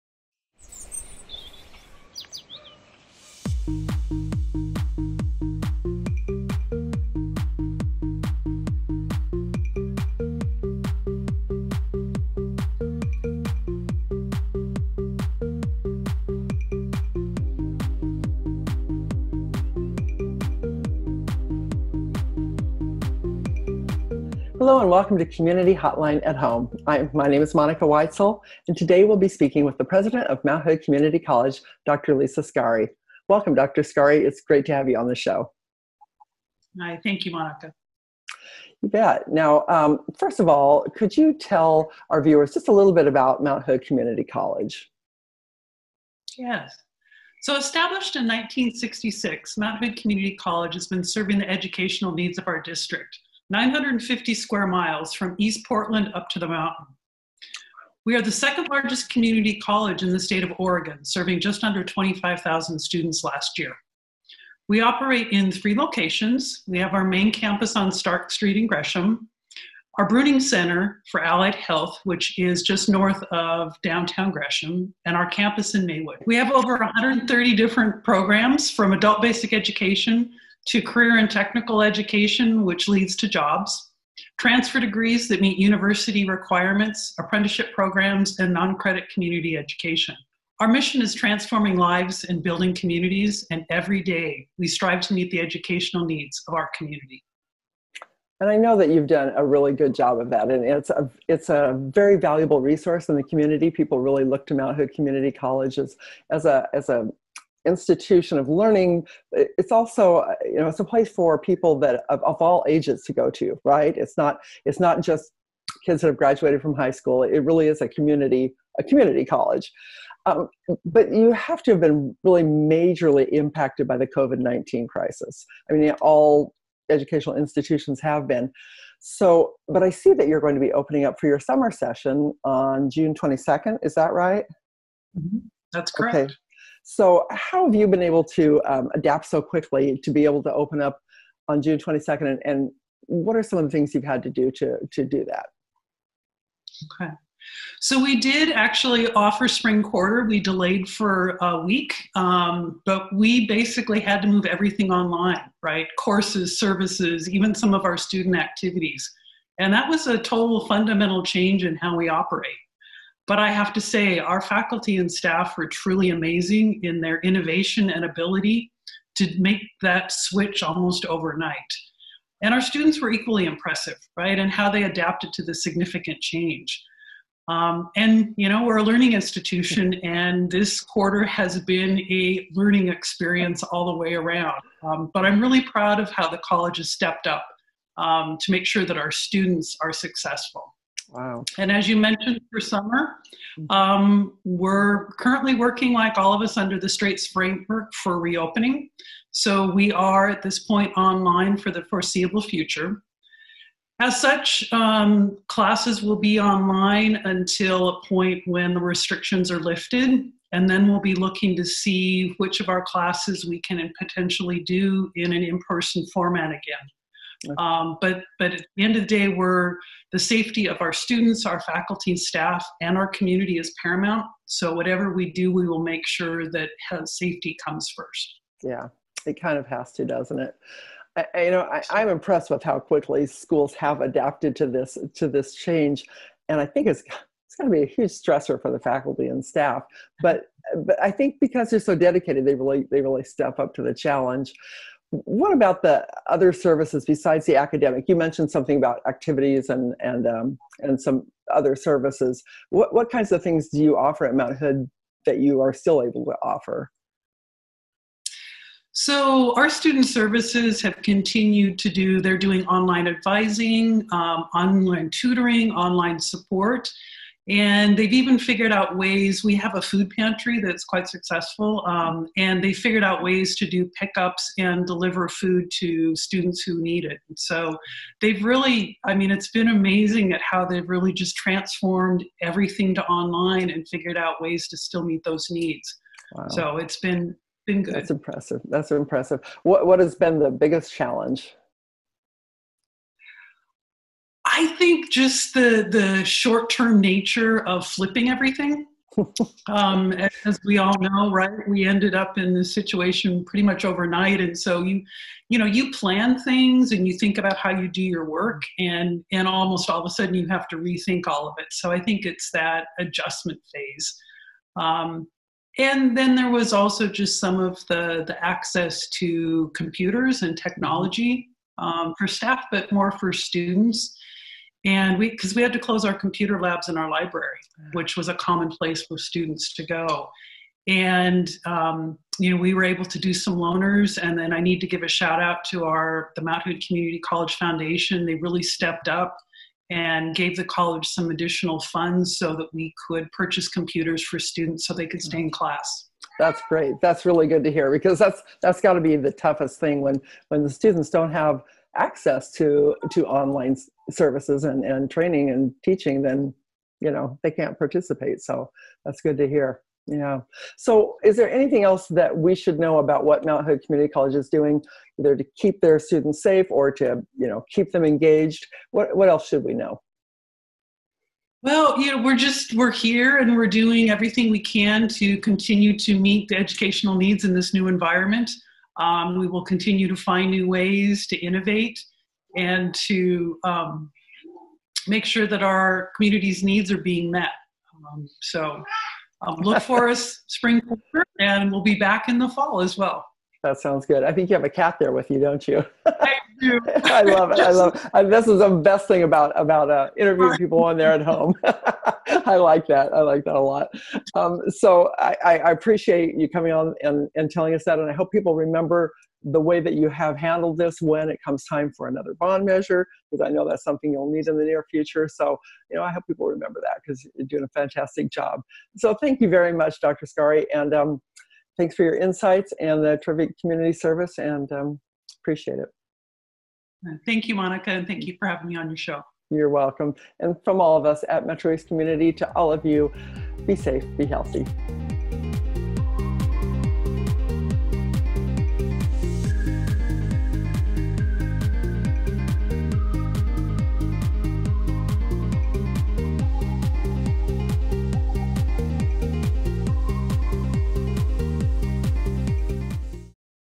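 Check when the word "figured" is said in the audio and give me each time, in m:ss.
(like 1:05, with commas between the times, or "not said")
4:28, 4:32, 4:43.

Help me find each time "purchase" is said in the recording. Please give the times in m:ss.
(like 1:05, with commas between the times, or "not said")
5:43.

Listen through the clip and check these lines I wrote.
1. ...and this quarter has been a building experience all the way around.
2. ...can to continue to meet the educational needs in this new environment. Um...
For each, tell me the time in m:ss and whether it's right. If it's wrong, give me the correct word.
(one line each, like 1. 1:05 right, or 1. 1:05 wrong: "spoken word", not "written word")
1. 3:00 wrong: "learning", not "building"
2. 6:14 right.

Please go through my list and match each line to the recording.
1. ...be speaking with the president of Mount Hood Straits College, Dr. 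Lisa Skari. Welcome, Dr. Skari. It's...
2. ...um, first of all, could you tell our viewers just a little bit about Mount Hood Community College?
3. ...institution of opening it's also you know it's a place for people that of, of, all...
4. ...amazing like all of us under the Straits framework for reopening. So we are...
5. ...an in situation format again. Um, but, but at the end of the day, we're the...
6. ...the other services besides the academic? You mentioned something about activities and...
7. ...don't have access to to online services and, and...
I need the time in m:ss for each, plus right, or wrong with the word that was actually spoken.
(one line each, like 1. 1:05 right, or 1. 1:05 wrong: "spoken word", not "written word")
1. 0:29 wrong: "Community", not "Straits"
2. 0:39 right
3. 1:47 wrong: "learning", not "opening"
4. 3:15 wrong: "working", not "amazing"
5. 3:35 wrong: "person", not "situation"
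6. 4:05 right
7. 5:51 right.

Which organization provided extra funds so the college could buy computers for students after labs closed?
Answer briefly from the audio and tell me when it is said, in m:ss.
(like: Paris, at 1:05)
Mount Hood Community College Foundation, at 5:36.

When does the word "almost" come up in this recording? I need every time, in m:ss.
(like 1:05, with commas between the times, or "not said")
2:50, 5:09.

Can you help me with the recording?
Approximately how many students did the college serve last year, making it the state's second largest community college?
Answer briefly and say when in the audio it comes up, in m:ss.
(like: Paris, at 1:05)
just under 25,000, at 1:01.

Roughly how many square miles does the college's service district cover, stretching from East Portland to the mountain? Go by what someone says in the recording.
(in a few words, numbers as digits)
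950.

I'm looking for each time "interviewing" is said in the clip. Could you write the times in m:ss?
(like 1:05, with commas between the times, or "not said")
6:40.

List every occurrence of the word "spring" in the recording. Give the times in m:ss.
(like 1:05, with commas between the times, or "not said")
2:29, 6:30.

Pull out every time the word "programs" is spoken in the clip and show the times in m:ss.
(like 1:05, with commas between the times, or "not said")
1:18, 1:27.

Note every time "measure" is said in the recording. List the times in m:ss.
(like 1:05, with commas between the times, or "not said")
6:52.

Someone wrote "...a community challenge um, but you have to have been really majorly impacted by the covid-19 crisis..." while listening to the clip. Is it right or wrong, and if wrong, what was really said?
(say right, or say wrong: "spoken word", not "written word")
wrong: "college", not "challenge".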